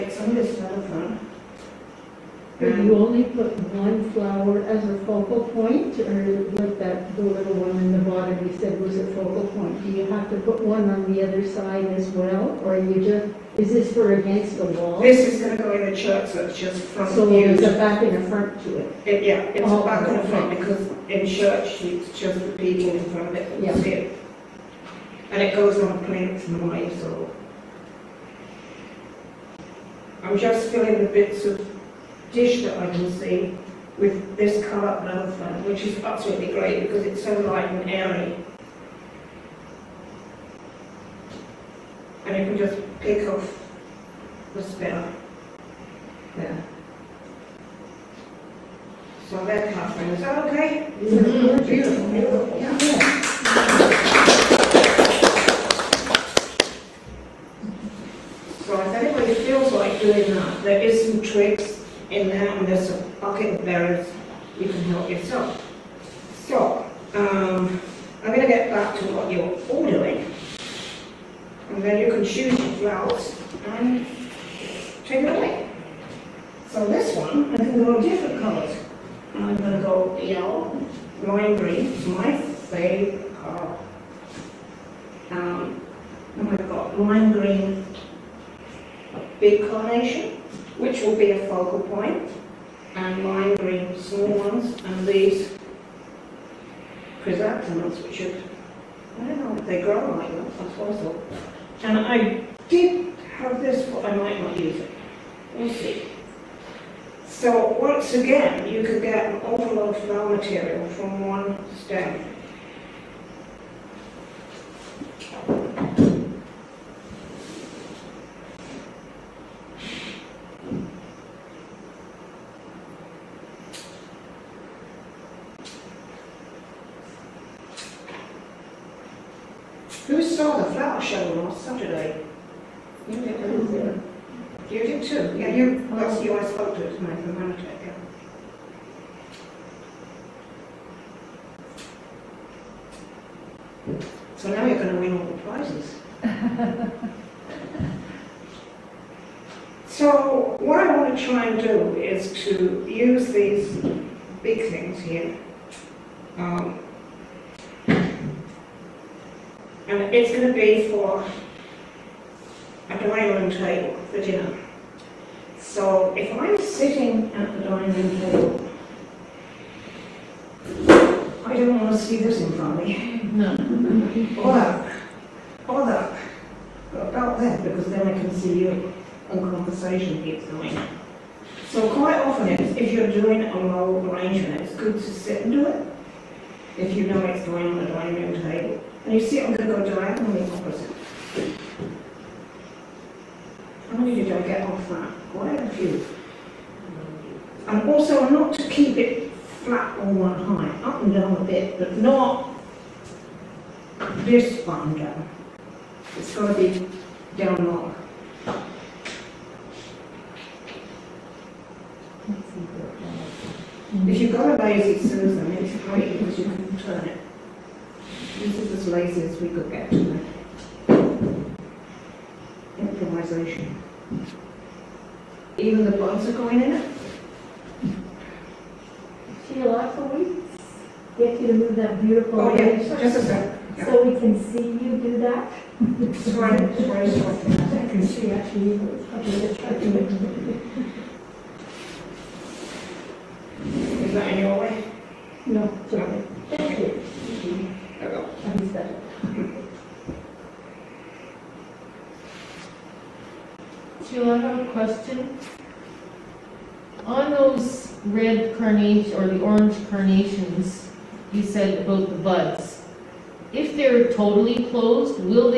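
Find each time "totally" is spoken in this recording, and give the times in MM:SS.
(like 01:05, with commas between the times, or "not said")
04:24.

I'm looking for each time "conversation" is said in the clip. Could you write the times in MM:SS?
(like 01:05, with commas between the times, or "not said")
02:59.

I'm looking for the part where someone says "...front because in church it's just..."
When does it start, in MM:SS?
00:20.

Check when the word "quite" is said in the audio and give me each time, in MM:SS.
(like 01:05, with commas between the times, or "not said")
03:01, 03:15.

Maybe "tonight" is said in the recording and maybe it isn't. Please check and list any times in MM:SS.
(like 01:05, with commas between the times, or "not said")
02:16, 03:39.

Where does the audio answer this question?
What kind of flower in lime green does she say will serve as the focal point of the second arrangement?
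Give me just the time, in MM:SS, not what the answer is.
01:29.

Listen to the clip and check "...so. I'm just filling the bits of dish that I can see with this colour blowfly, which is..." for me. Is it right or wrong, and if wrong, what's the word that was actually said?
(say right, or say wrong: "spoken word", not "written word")
right.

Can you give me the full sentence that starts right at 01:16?
So this one, I can go different colours.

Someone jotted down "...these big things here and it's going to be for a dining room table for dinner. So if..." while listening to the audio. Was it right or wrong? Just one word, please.
right.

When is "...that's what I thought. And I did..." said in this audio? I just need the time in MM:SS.
01:40.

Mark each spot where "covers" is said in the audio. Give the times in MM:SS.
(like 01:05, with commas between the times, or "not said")
00:49.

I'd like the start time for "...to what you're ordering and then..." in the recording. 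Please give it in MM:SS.
01:08.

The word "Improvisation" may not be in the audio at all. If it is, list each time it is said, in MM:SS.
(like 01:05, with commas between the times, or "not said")
03:42.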